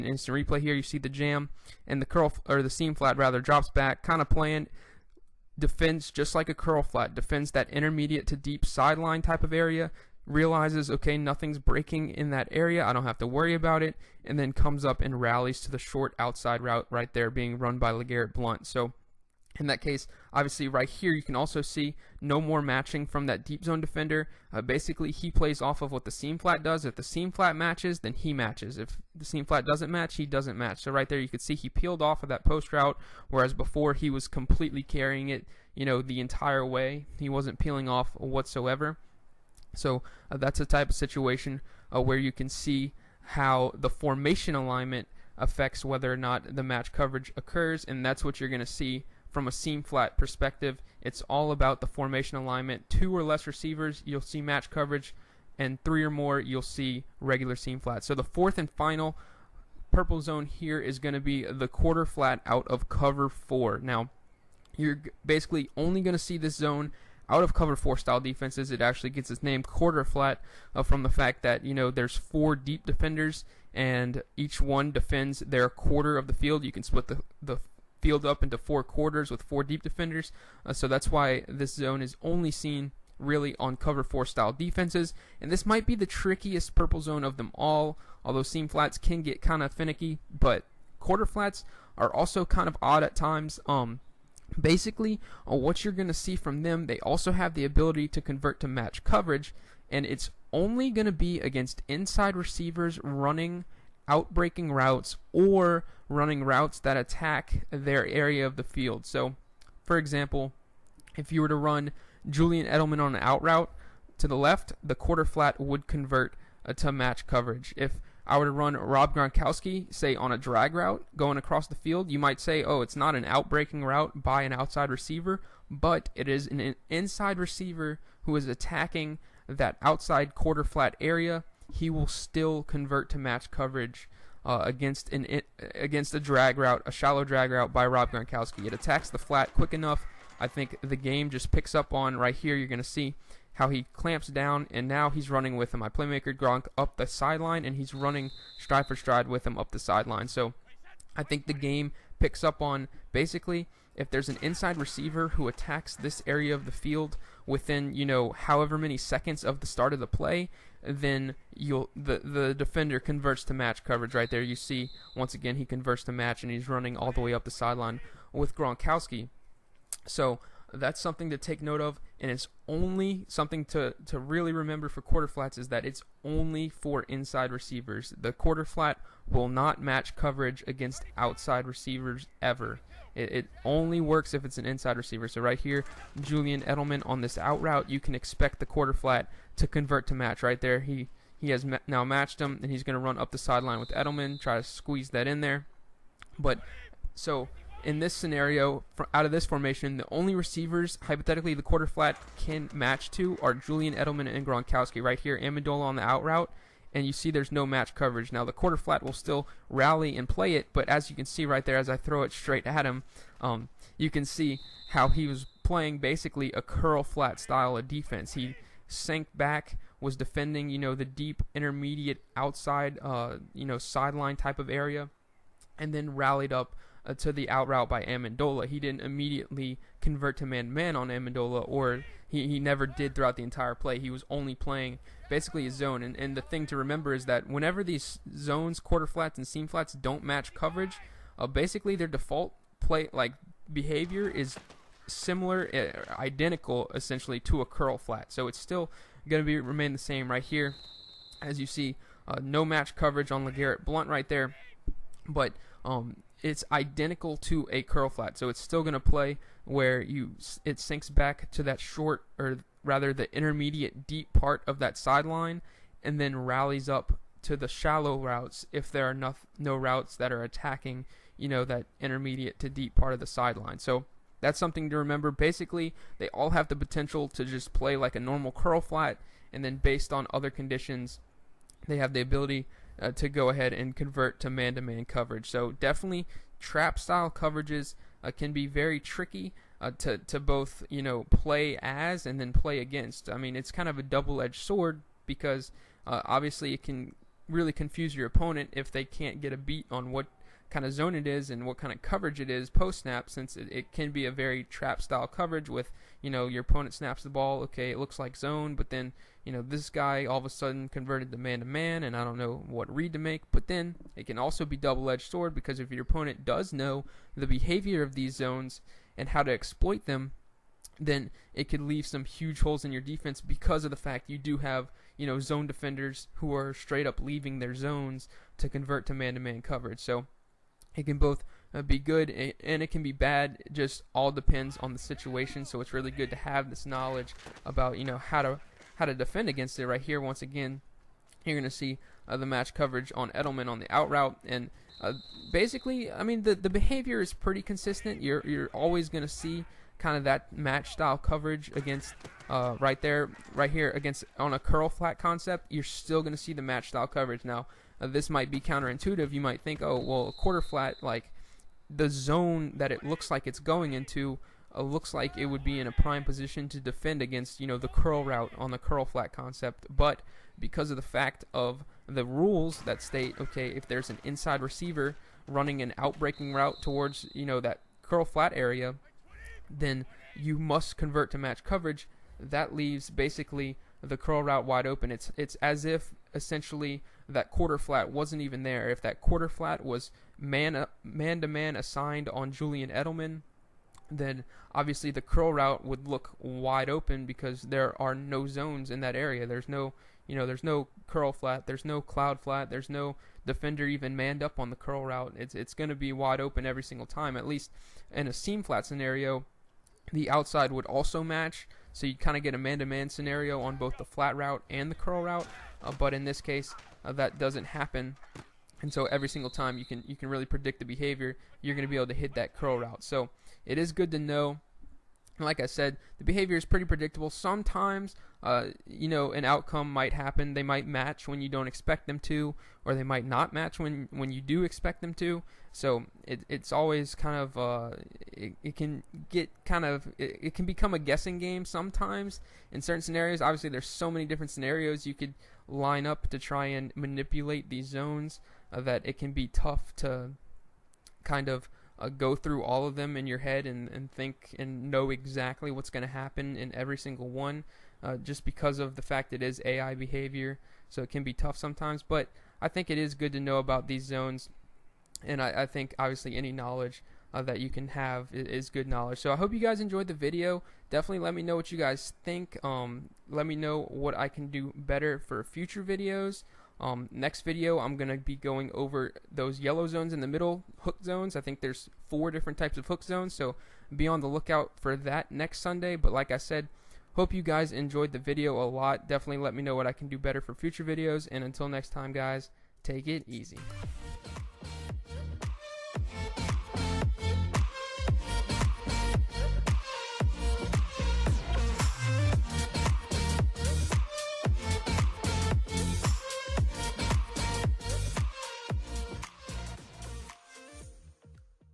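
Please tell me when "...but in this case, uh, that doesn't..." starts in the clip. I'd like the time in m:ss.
6:55.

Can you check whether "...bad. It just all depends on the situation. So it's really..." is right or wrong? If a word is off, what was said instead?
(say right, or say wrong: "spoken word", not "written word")
right.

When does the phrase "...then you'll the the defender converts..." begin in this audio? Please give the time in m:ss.
2:40.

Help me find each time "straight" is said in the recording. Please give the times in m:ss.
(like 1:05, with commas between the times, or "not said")
3:32, 5:26.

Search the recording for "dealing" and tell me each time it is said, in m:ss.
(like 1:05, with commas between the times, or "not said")
not said.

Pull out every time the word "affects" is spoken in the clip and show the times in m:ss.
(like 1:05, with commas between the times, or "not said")
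0:45.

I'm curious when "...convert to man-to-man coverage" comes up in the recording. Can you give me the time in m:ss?
4:43.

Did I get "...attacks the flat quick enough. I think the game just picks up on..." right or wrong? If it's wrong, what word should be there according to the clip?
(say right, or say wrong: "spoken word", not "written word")
right.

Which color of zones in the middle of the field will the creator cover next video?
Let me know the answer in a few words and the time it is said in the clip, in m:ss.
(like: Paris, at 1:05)
yellow, at 7:59.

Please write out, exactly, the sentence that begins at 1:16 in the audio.
You can split the the field up into four quarters with four deep defenders.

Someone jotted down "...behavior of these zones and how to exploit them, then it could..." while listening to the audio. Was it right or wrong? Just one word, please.
right.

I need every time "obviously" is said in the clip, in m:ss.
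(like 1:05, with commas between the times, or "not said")
0:20, 4:56, 6:34, 7:23, 7:45.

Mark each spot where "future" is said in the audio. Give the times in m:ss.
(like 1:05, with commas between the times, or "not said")
7:55, 8:10.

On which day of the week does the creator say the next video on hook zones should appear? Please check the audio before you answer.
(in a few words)
Sunday.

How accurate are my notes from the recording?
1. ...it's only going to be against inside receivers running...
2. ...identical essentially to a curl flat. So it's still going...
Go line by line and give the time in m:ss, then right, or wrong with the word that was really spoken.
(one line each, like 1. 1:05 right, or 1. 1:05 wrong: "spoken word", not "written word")
1. 1:40 right
2. 4:06 right.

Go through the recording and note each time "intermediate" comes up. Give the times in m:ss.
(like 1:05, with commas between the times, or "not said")
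0:07, 3:41, 4:23, 4:31.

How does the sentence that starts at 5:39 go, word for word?
Right here, once again, you're going to see uh, the match coverage on Edelman on the out route and.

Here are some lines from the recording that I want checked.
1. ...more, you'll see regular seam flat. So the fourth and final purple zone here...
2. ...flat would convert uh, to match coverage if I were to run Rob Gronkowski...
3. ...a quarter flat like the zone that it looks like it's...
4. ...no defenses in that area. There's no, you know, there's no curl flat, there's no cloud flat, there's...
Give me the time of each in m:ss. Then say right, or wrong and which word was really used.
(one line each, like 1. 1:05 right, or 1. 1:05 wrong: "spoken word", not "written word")
1. 0:56 right
2. 1:55 right
3. 6:00 right
4. 6:38 wrong: "zones", not "defenses".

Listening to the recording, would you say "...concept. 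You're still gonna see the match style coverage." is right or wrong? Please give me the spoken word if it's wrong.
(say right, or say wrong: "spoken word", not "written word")
right.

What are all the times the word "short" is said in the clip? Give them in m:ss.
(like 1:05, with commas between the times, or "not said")
0:15, 4:21.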